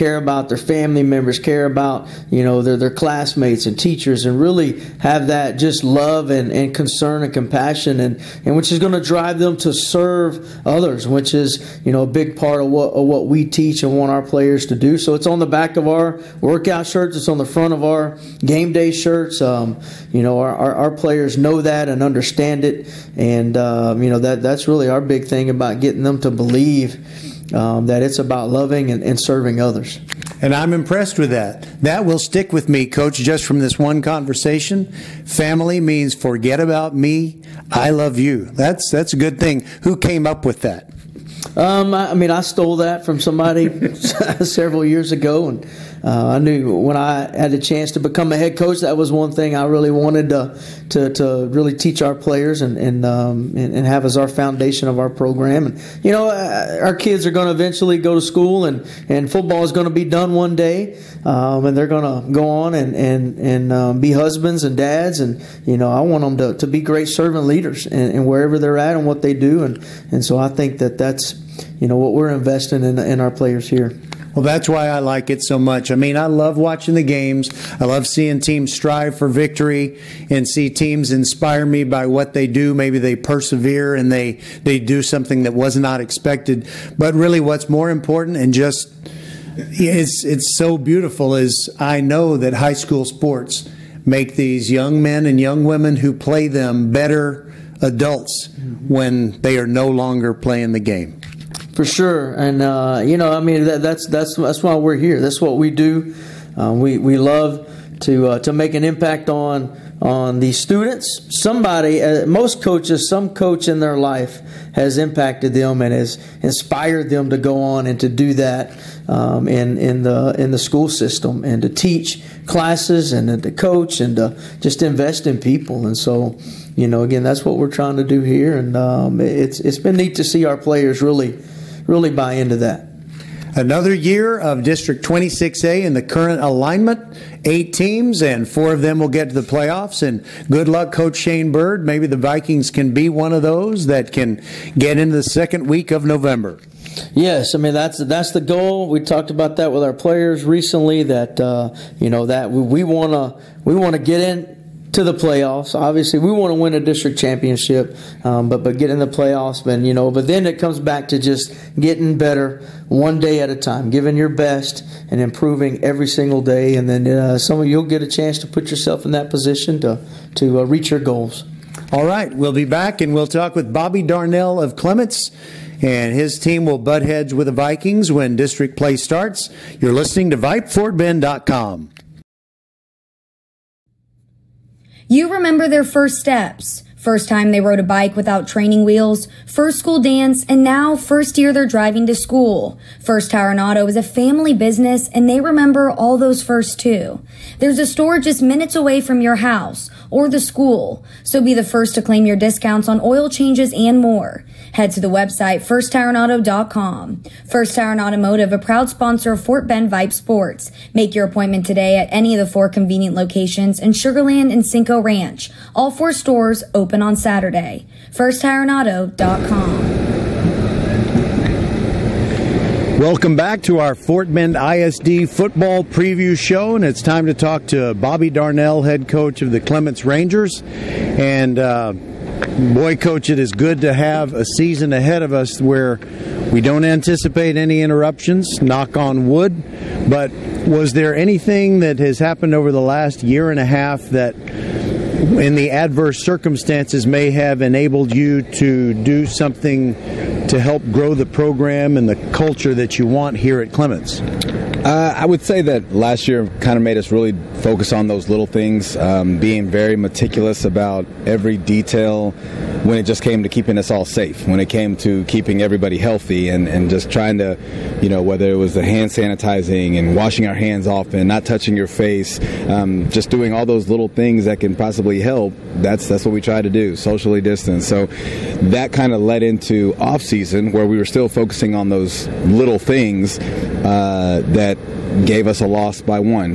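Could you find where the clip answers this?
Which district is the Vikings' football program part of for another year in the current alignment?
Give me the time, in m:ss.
2:14.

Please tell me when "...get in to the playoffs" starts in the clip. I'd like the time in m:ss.
2:33.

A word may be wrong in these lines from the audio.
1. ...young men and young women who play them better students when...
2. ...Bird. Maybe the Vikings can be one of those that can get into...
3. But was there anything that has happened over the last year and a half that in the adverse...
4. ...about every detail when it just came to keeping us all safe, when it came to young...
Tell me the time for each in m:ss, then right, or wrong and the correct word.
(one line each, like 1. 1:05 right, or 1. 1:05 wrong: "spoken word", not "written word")
1. 1:34 wrong: "adults", not "students"
2. 2:21 right
3. 4:00 right
4. 4:20 wrong: "keeping", not "young".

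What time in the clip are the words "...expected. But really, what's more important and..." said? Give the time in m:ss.
1:25.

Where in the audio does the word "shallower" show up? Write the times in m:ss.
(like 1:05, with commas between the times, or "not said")
not said.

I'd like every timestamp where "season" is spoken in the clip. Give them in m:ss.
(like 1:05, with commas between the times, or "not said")
3:54, 4:40.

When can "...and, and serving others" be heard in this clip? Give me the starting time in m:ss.
0:28.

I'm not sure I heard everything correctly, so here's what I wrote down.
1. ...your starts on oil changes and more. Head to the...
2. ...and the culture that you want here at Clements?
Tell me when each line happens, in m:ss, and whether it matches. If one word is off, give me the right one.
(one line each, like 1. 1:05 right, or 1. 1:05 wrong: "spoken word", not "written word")
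1. 3:22 wrong: "discounts", not "starts"
2. 4:11 right.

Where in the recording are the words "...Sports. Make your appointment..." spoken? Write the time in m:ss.
3:30.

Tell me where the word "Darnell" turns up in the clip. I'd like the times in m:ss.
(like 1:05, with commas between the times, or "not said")
2:54, 3:48.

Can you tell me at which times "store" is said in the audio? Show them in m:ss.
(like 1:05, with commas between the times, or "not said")
3:17, 3:36.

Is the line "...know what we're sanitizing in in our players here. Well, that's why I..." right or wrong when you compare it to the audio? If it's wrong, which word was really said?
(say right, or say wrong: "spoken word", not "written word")
wrong: "investing", not "sanitizing".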